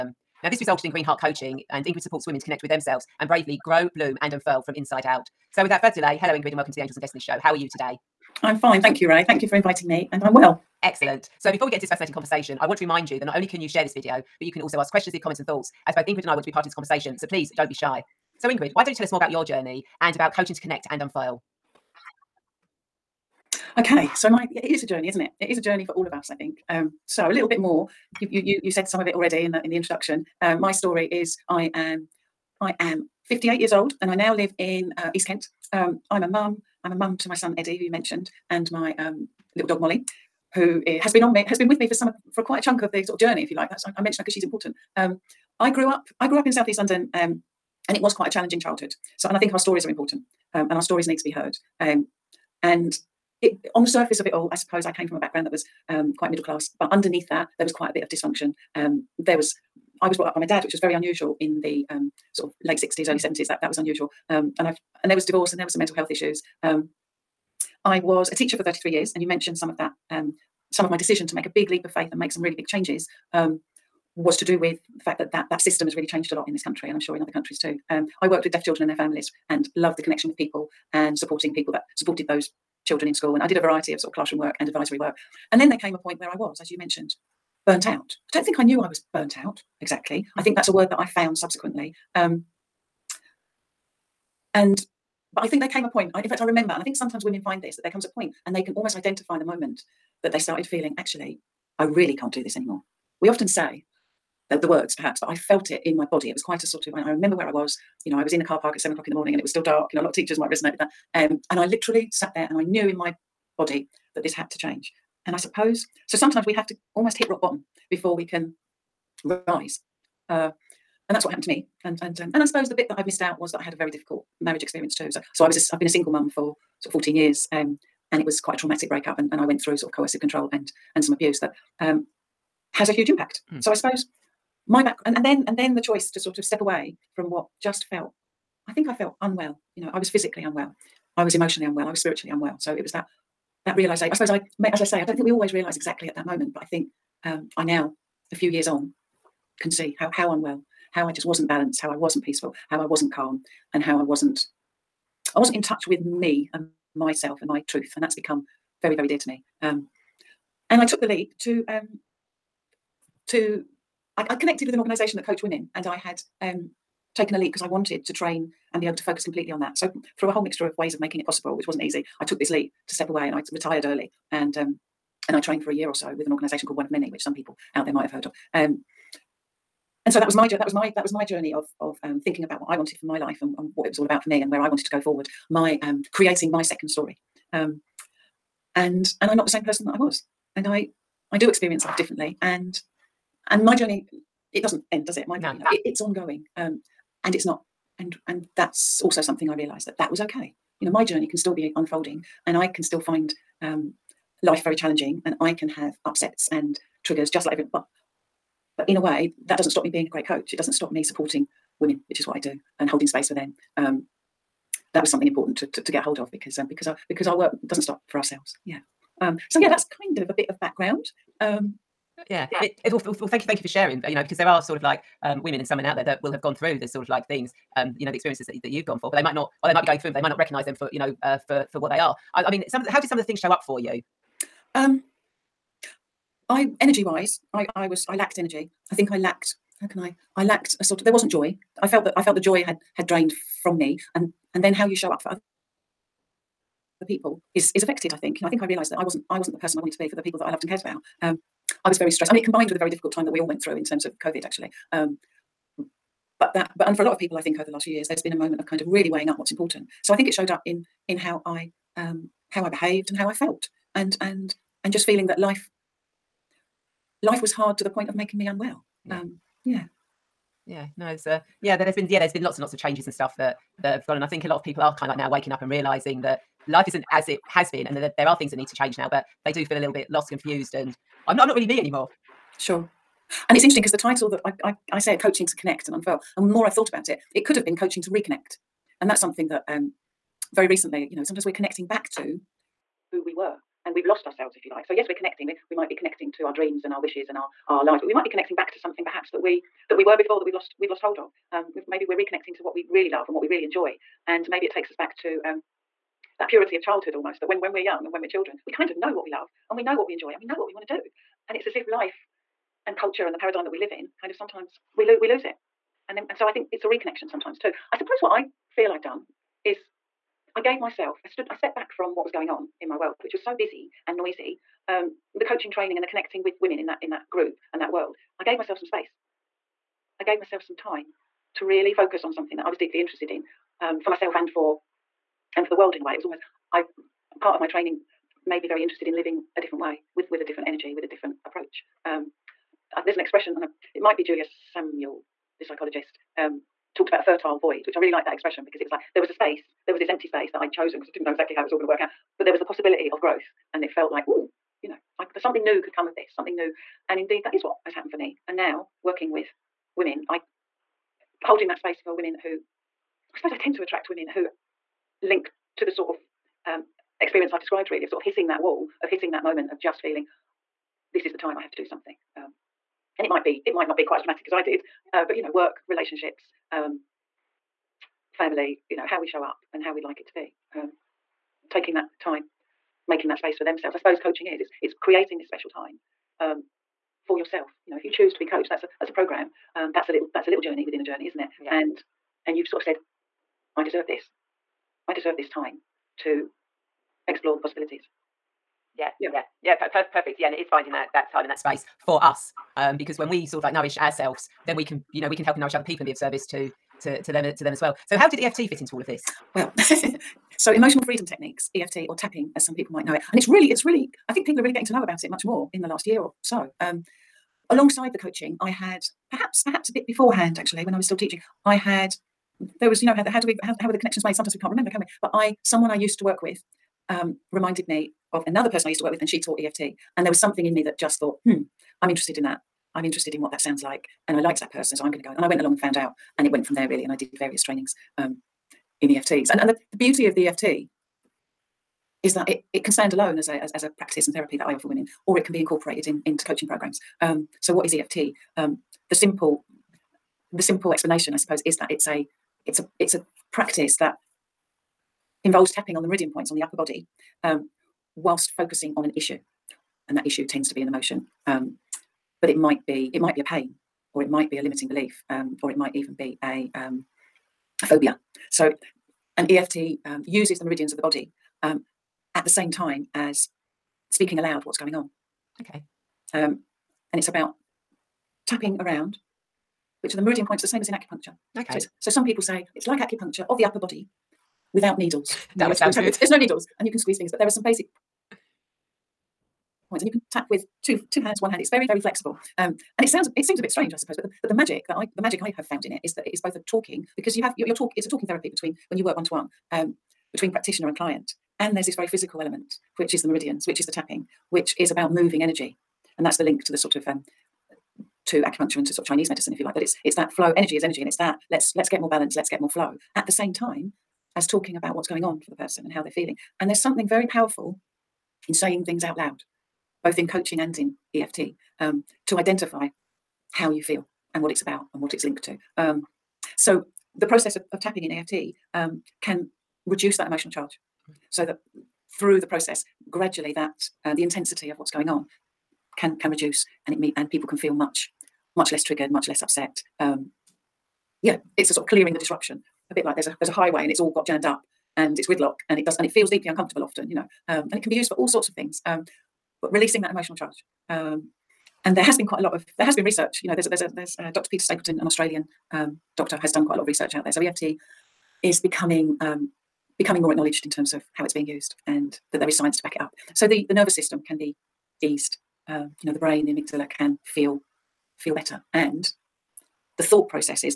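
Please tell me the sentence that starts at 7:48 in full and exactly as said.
So, an EFT um, uses the meridians of the body um, at the same time as speaking aloud what's going on.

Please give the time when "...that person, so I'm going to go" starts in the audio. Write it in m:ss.
7:14.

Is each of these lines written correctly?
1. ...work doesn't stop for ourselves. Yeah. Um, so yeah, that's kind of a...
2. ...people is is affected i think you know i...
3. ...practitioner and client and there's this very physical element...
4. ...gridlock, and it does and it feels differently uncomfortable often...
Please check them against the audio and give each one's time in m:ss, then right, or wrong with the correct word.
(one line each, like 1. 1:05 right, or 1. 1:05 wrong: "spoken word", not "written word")
1. 3:37 right
2. 4:07 right
3. 8:20 right
4. 9:05 wrong: "deeply", not "differently".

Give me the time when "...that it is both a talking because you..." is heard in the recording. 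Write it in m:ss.
8:16.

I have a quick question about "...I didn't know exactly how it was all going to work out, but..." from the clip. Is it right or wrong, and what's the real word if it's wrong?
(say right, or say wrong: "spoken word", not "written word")
right.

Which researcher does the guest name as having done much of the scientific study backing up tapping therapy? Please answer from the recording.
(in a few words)
Peta Stapleton.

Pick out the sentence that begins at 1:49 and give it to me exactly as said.
You know, a lot of teachers might resonate with that.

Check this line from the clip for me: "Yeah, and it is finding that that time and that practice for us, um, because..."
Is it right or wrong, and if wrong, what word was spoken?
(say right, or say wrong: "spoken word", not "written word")
wrong: "space", not "practice".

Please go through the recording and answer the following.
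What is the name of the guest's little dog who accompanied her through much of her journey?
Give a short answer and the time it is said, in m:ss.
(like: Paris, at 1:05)
Molly, at 0:39.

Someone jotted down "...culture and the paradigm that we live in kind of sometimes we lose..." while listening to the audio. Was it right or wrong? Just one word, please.
right.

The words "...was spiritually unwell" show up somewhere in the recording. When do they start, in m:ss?
2:21.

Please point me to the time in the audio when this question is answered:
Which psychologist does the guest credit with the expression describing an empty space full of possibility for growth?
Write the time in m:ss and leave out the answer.
5:44.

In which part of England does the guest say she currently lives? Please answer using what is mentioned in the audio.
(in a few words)
East Kent.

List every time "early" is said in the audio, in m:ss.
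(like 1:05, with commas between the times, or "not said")
1:03, 2:53.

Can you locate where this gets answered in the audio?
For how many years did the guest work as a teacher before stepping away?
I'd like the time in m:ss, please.
1:08.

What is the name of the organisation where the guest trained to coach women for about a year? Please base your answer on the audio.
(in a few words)
One of Many.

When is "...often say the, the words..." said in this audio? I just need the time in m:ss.
1:43.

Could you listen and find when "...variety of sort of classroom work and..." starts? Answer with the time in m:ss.
1:23.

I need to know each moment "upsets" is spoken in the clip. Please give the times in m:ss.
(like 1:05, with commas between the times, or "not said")
3:26, 8:59.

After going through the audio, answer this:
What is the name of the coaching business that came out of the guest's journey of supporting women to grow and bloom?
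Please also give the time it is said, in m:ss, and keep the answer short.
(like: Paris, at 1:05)
Green Heart coaching, at 0:00.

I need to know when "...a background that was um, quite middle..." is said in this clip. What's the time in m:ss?
0:55.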